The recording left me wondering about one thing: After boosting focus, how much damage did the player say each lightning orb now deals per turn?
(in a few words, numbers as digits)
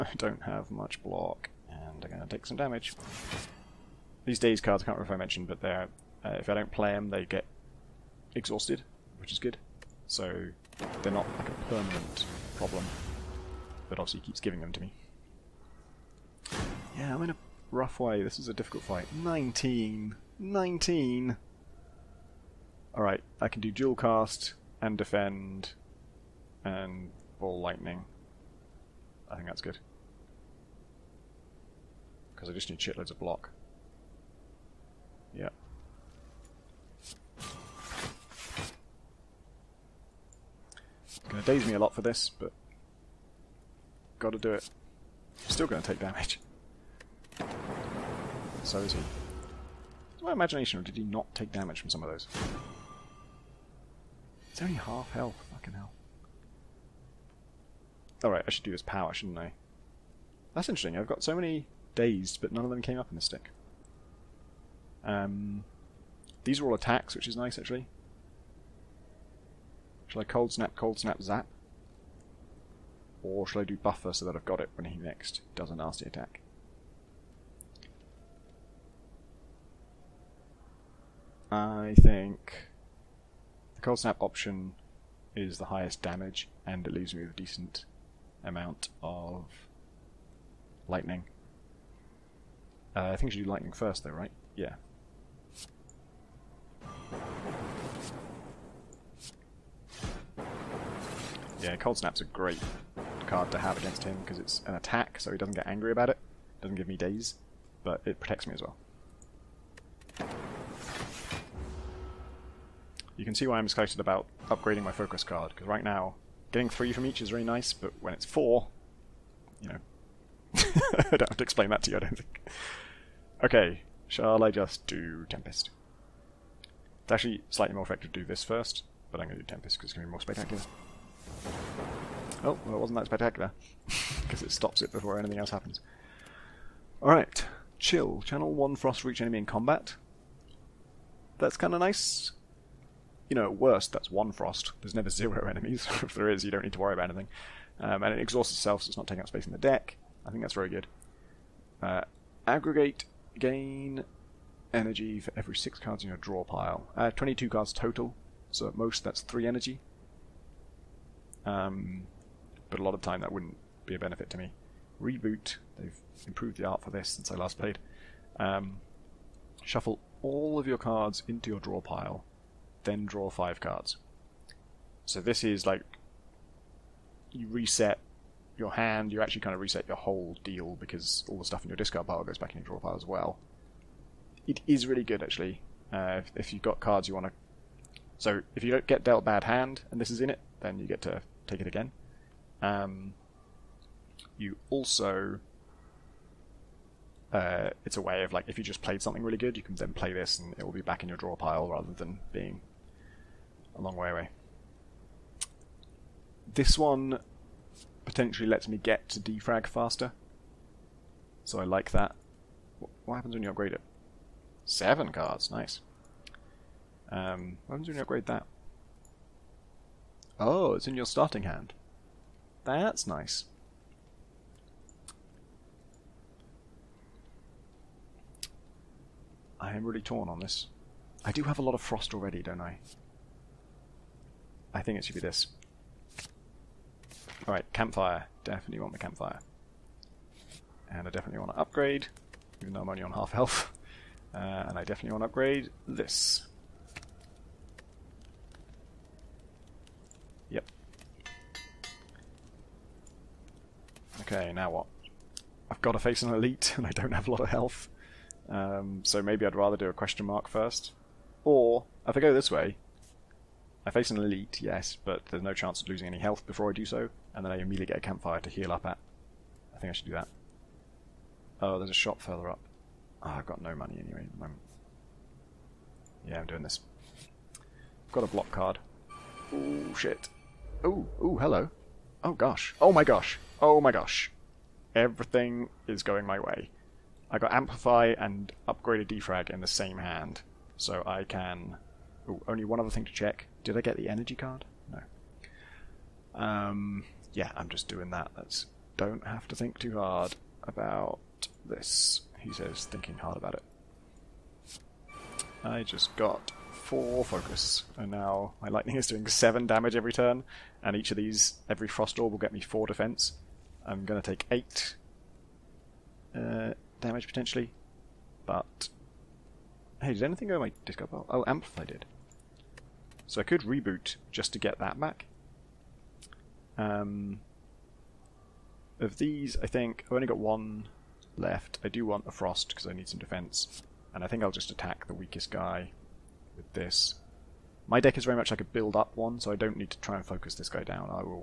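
7.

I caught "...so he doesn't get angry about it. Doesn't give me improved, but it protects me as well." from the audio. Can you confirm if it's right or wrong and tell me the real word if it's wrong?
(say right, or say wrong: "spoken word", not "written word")
wrong: "dazed", not "improved".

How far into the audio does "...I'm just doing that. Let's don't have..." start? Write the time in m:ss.
4:57.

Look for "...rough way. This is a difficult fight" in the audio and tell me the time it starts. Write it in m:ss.
0:17.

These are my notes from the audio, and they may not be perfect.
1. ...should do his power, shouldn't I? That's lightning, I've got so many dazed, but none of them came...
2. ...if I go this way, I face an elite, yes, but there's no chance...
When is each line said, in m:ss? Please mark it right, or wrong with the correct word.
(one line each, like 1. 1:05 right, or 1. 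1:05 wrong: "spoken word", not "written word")
1. 0:58 wrong: "interesting", not "lightning"
2. 4:22 right.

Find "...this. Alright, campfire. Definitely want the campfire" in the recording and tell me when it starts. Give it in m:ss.
3:55.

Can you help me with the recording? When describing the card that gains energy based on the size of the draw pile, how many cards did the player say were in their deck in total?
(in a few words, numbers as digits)
22.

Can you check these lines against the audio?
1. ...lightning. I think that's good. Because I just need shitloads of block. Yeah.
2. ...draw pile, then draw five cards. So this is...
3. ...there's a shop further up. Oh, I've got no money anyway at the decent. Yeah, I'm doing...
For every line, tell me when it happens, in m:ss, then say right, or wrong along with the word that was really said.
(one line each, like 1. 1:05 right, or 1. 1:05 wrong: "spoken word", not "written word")
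1. 0:27 right
2. 2:51 right
3. 4:31 wrong: "moment", not "decent".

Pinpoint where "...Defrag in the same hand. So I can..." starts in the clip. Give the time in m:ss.
4:49.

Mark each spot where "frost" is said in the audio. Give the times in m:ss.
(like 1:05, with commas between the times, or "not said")
2:18, 2:24, 3:51, 5:11, 5:32.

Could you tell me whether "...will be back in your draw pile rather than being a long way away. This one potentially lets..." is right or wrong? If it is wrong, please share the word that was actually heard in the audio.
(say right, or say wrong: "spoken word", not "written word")
right.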